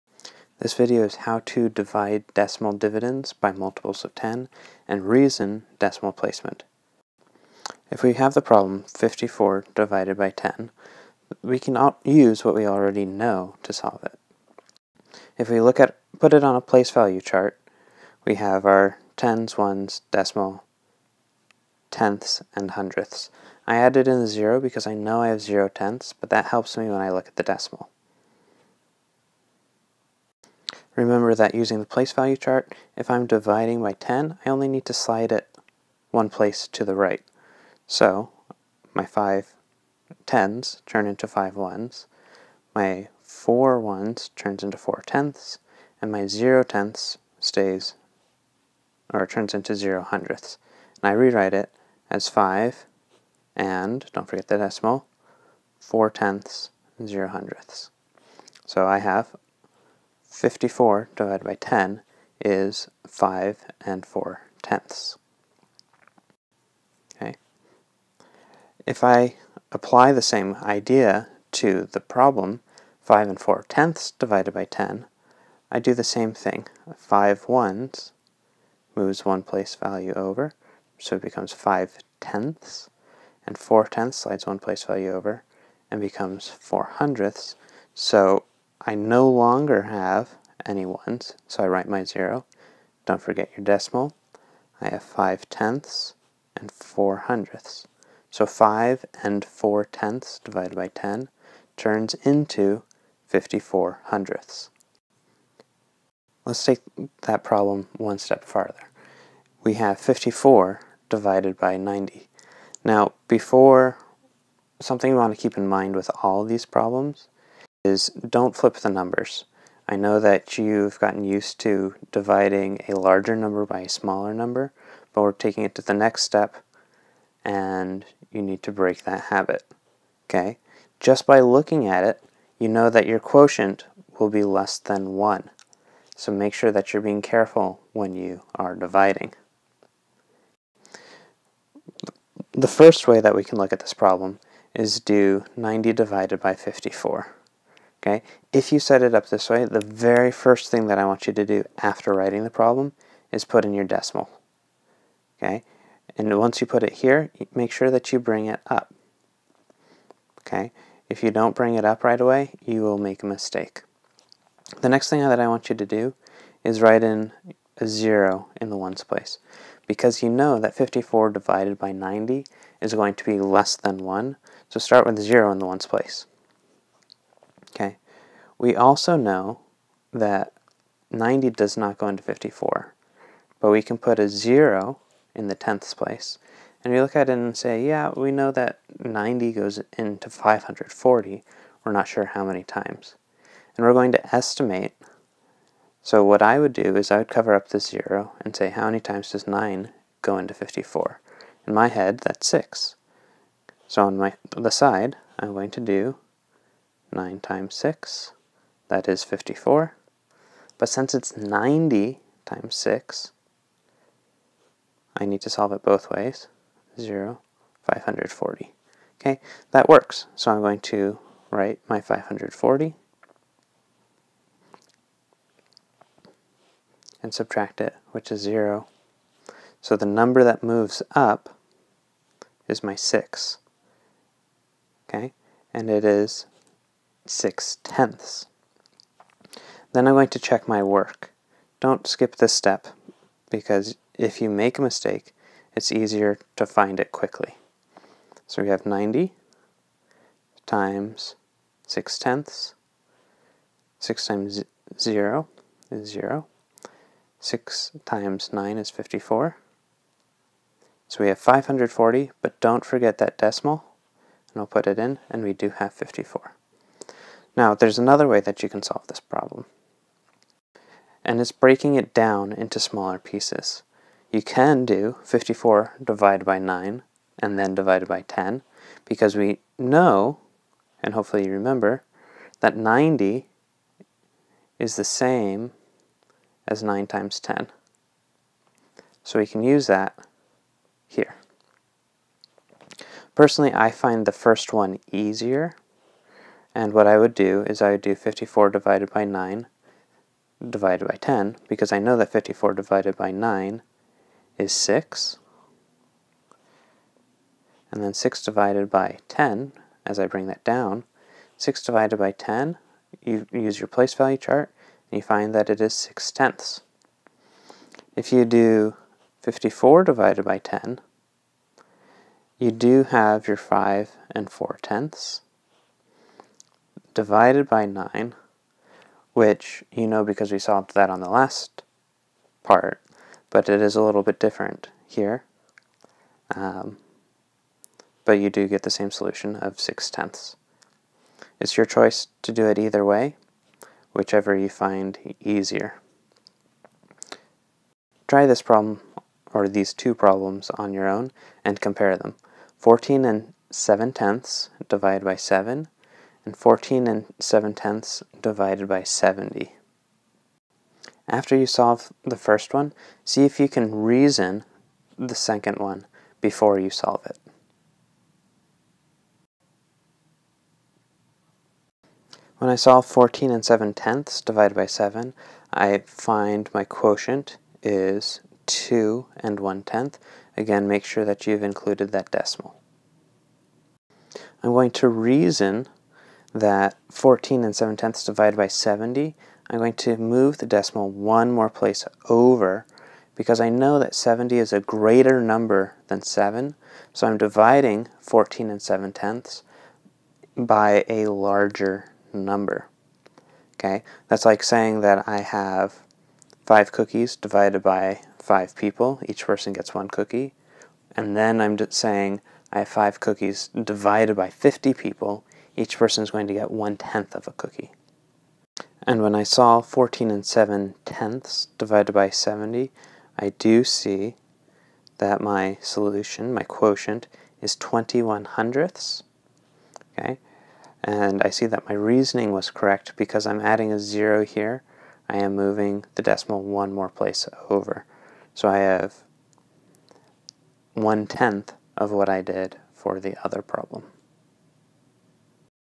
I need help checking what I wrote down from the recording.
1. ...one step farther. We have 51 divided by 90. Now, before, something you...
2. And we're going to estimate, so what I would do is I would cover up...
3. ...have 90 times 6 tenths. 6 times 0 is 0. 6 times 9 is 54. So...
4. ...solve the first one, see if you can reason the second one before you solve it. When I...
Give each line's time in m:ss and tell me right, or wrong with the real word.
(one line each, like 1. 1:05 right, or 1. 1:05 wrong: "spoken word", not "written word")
1. 1:47 wrong: "54", not "51"
2. 3:13 right
3. 4:08 right
4. 6:01 right.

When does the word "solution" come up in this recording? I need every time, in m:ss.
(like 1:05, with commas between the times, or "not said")
5:39, 7:05.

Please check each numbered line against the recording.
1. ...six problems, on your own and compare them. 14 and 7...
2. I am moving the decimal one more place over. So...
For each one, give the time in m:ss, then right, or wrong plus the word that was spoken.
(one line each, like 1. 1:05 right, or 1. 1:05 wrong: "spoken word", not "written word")
1. 5:49 wrong: "two", not "six"
2. 7:15 right.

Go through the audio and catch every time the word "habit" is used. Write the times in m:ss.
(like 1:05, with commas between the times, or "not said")
2:09.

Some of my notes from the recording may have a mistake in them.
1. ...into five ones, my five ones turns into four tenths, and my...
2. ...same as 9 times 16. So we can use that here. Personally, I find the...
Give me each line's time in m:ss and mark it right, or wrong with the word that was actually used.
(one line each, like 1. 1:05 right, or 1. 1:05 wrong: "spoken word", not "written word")
1. 0:41 wrong: "four", not "five"
2. 4:45 wrong: "10", not "16".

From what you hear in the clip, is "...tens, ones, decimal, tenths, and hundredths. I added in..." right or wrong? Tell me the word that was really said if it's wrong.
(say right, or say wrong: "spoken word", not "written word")
right.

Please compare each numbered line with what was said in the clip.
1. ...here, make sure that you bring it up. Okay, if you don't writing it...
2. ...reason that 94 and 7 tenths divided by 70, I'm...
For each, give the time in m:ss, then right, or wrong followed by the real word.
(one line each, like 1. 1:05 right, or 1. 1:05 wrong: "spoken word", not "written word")
1. 2:36 wrong: "bring", not "writing"
2. 6:25 wrong: "14", not "94".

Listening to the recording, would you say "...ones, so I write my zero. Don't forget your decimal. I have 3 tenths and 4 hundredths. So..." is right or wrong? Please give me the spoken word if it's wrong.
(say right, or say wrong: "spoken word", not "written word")
wrong: "5", not "3".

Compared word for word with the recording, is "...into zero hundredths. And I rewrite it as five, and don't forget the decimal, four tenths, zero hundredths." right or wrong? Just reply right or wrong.
right.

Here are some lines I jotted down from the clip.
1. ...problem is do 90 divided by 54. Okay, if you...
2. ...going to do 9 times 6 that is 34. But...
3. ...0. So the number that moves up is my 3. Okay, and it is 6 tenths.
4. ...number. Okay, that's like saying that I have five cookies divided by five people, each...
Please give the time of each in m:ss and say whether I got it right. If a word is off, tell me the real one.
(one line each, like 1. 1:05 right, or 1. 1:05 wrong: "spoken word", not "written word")
1. 2:23 right
2. 3:25 wrong: "54", not "34"
3. 3:48 wrong: "6", not "3"
4. 6:42 right.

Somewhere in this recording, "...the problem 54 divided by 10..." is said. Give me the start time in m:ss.
0:08.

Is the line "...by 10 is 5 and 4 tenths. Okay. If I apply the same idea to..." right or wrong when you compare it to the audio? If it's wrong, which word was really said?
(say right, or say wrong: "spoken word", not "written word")
right.